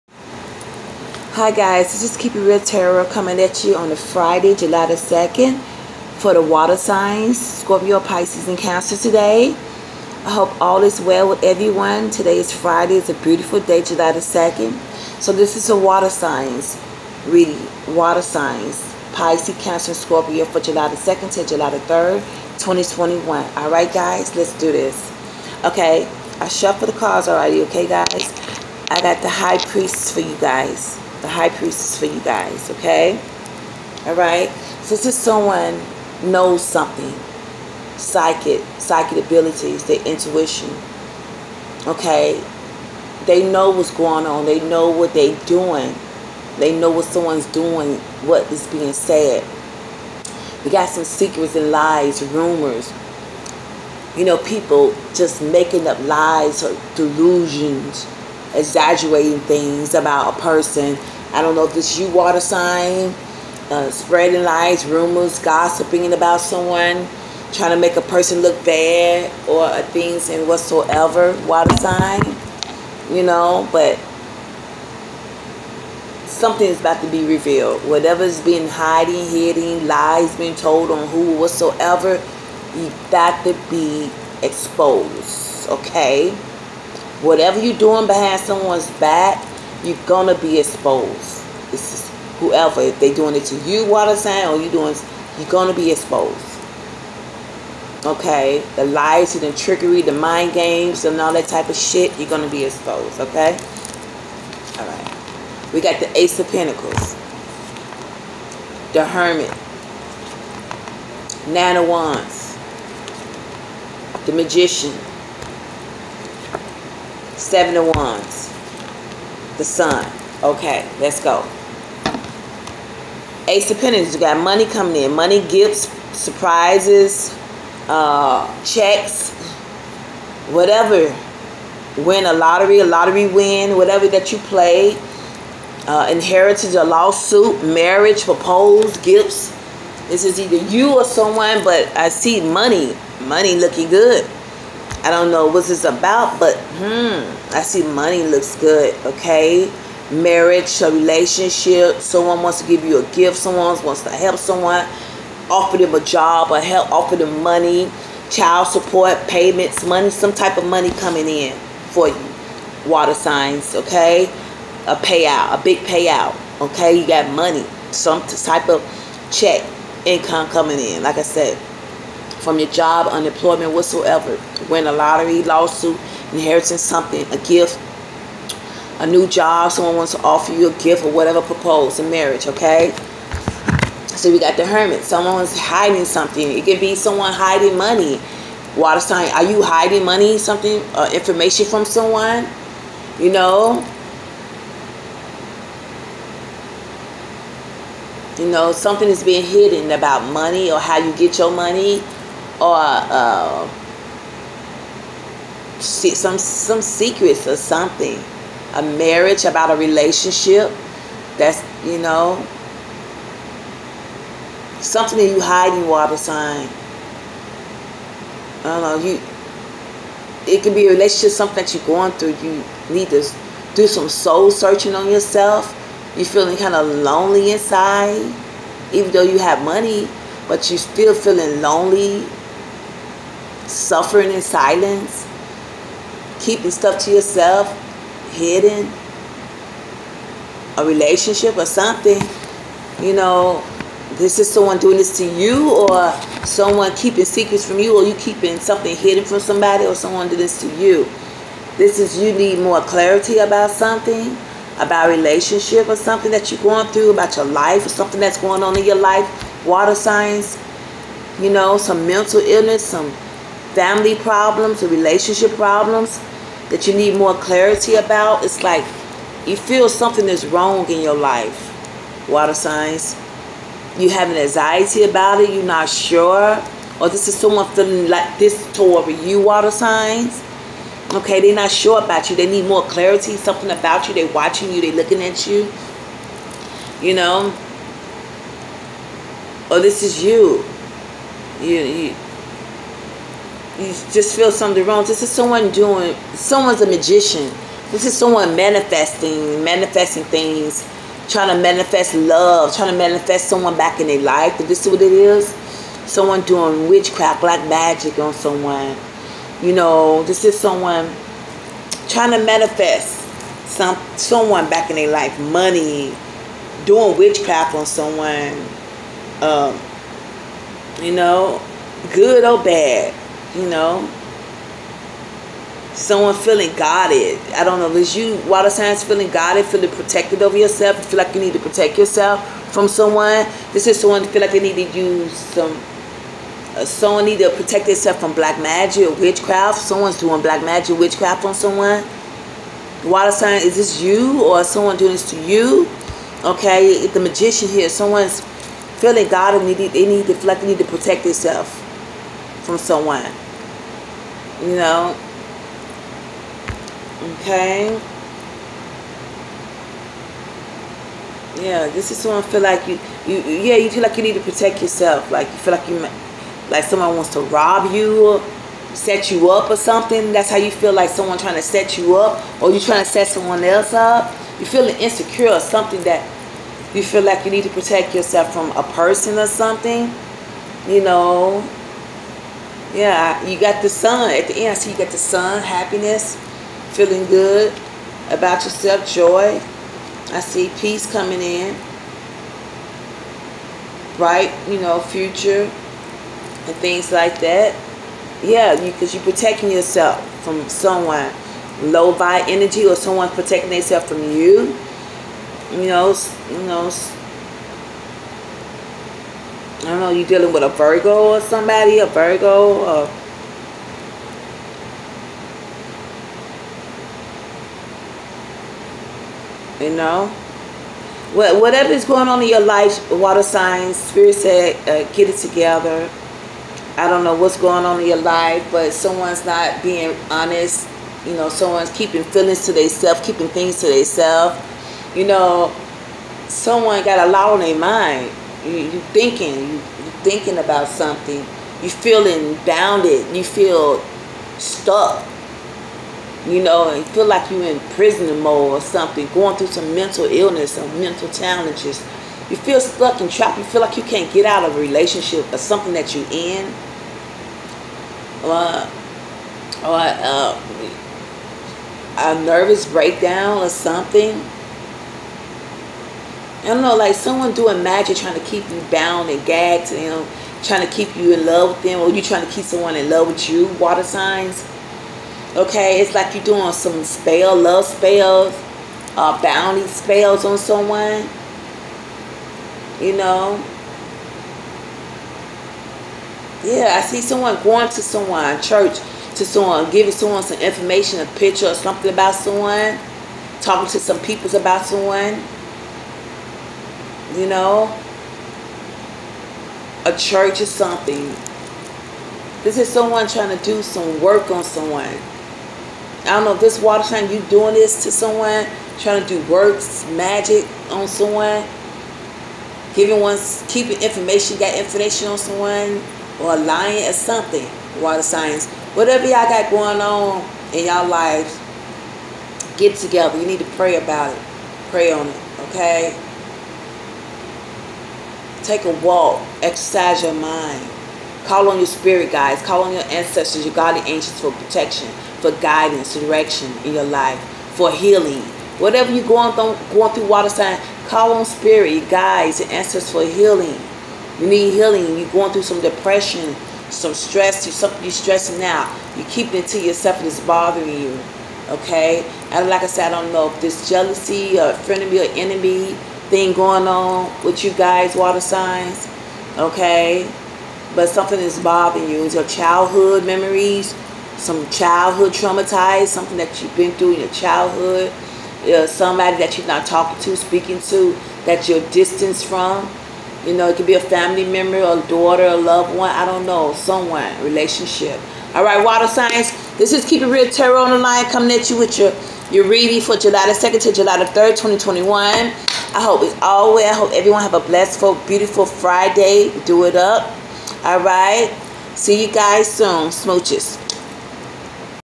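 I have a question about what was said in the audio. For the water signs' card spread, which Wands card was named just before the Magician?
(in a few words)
Nine of Wands.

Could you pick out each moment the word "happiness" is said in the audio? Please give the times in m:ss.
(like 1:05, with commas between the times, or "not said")
6:25.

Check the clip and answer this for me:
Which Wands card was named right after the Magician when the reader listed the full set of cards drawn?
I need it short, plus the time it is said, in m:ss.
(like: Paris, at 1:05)
Seven of Wands, at 1:57.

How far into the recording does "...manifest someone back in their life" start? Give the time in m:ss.
5:02.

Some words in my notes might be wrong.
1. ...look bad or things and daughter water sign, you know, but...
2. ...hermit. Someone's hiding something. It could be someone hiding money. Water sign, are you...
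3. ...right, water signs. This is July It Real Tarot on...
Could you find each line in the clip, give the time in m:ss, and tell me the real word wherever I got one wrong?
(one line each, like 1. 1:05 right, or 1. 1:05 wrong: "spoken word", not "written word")
1. 1:08 wrong: "whatsoever", not "daughter"
2. 3:04 right
3. 9:38 wrong: "Keep", not "July".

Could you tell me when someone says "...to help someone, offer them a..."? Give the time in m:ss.
2:34.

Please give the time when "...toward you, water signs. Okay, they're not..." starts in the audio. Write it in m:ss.
4:38.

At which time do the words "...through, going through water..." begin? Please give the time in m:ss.
8:59.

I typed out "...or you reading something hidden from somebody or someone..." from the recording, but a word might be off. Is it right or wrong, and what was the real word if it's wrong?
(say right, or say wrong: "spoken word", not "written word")
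wrong: "keeping", not "reading".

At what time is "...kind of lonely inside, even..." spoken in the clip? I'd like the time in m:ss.
3:46.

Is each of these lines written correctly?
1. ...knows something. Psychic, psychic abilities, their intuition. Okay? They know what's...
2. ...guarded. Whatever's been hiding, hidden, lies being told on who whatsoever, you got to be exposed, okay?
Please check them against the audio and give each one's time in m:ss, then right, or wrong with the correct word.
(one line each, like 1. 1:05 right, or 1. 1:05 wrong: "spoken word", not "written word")
1. 0:36 right
2. 1:17 wrong: "revealed", not "guarded".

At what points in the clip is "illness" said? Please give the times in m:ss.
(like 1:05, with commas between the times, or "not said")
4:22, 7:30.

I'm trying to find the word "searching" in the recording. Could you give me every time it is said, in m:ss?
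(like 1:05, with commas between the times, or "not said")
3:44.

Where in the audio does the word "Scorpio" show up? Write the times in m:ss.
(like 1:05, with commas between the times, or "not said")
0:07, 0:19.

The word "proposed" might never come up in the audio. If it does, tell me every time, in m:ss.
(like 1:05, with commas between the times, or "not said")
2:18, 3:01.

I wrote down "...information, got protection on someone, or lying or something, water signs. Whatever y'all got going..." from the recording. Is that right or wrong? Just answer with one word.
wrong.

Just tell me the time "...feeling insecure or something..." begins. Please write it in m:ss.
6:14.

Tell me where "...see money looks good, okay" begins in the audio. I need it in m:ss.
2:27.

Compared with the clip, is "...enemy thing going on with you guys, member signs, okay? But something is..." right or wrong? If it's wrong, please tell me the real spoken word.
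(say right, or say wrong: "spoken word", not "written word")
wrong: "water", not "member".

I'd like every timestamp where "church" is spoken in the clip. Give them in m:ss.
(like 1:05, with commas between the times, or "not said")
8:08, 8:20.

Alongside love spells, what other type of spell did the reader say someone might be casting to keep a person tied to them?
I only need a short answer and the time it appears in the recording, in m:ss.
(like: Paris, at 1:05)
bounty spells, at 7:59.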